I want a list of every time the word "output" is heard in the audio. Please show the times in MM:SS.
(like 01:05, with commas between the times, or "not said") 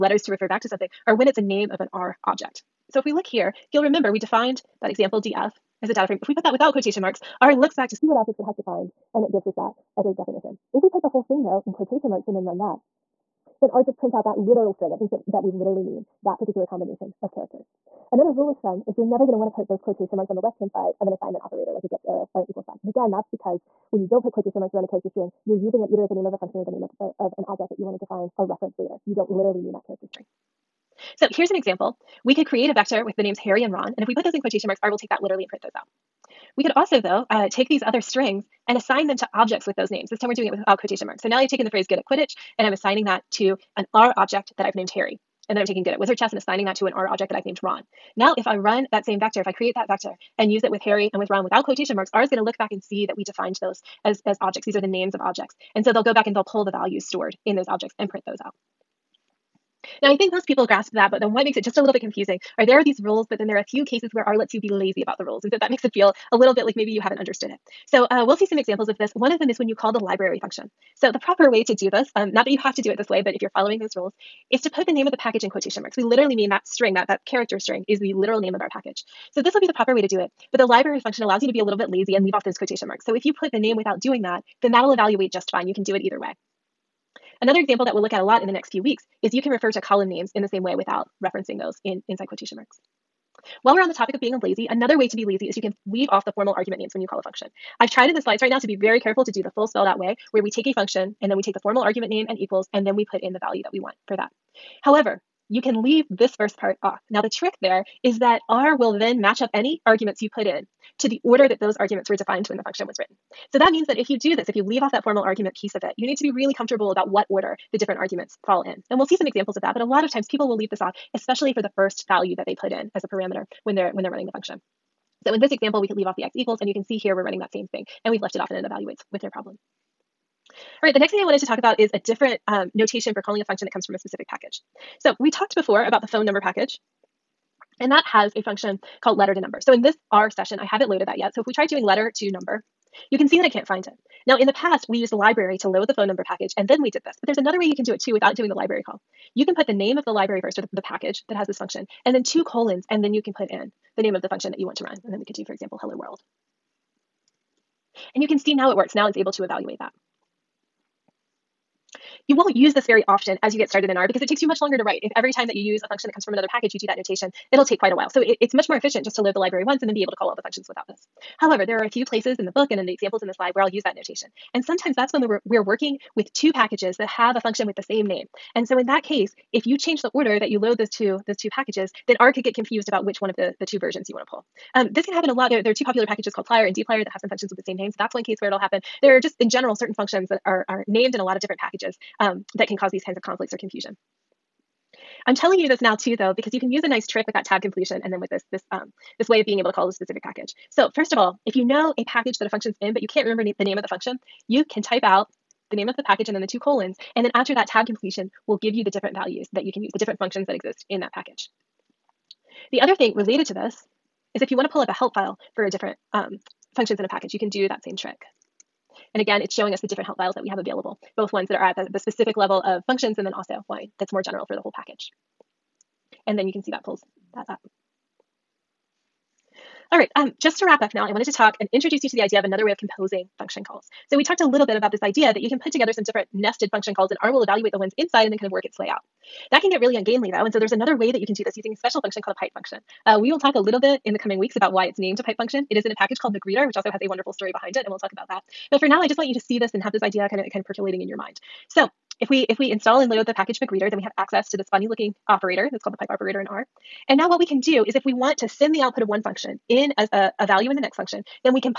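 04:18.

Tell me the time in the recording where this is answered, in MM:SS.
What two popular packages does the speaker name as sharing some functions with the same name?
03:06.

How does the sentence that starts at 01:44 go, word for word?
However, you can leave this first part off.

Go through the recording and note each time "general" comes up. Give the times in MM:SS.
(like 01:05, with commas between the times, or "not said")
03:09, 03:44.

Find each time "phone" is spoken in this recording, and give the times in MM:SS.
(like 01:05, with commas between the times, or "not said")
02:16, 02:25.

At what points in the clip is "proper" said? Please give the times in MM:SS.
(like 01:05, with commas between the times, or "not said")
01:11, 01:19.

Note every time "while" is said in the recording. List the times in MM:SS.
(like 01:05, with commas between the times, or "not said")
01:33, 02:47.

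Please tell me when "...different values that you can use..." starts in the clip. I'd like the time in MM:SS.
03:28.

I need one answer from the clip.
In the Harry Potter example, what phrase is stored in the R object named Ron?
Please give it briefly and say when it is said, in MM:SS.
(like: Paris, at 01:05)
good at wizard chess, at 00:45.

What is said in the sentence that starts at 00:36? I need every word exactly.
We could also, though, uh, take these other strings and assign them to objects with those names.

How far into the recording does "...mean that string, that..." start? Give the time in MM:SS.
01:16.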